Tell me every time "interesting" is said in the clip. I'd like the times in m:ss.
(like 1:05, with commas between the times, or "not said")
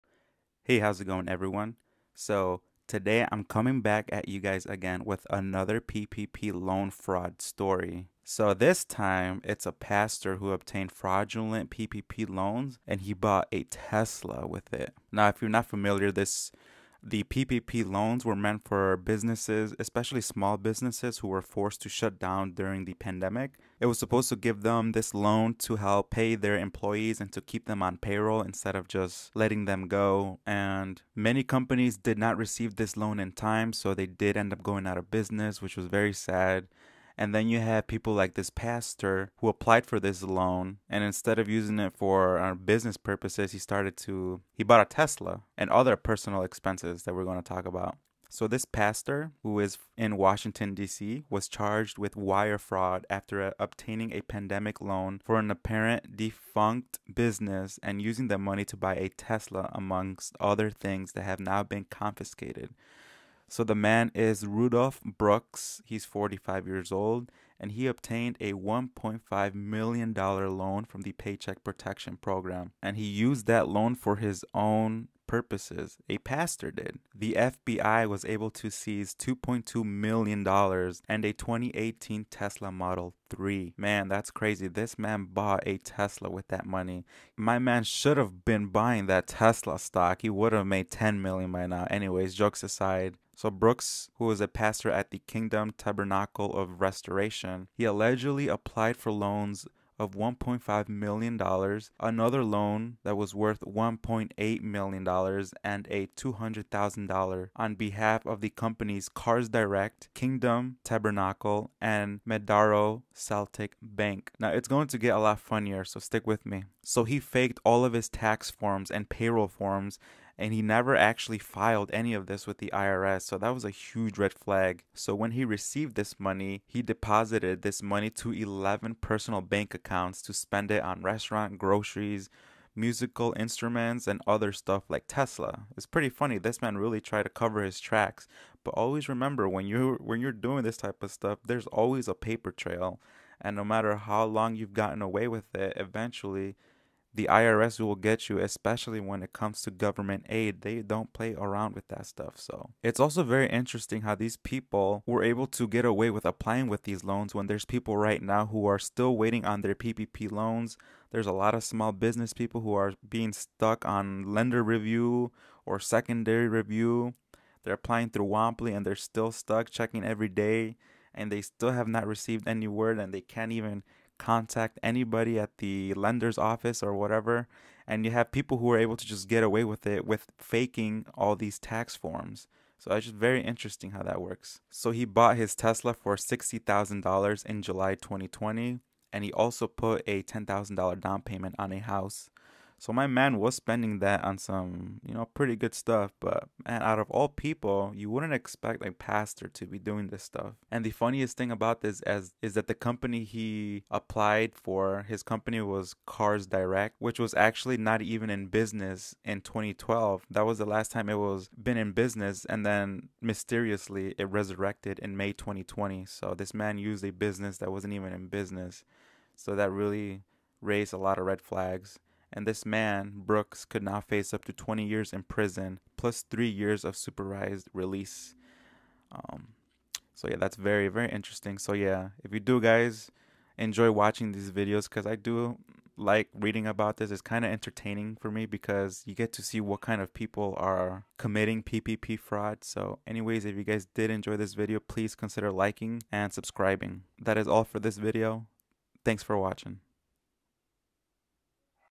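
2:33, 3:03, 3:51.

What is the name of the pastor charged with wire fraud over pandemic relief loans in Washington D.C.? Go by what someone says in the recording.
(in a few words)
Rudolph Brooks.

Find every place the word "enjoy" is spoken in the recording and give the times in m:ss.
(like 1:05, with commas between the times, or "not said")
3:53, 4:04.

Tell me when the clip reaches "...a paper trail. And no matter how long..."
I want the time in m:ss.
2:22.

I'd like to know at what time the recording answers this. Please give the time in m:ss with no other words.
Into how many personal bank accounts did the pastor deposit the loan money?
2:08.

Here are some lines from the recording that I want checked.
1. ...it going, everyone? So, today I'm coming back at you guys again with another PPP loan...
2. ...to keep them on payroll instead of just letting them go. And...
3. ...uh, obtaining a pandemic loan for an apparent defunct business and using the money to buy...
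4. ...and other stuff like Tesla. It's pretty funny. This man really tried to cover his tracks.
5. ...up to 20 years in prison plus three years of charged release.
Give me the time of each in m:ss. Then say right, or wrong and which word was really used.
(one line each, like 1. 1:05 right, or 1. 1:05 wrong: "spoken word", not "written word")
1. 0:01 right
2. 0:27 right
3. 0:53 right
4. 2:14 right
5. 3:44 wrong: "supervised", not "charged".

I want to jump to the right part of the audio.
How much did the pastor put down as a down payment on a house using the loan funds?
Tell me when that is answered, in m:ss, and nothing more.
3:10.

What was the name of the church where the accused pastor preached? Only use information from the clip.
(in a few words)
Kingdom Tabernacle of Restoration.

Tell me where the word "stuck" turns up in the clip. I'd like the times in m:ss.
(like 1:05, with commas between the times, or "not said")
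2:43, 2:49.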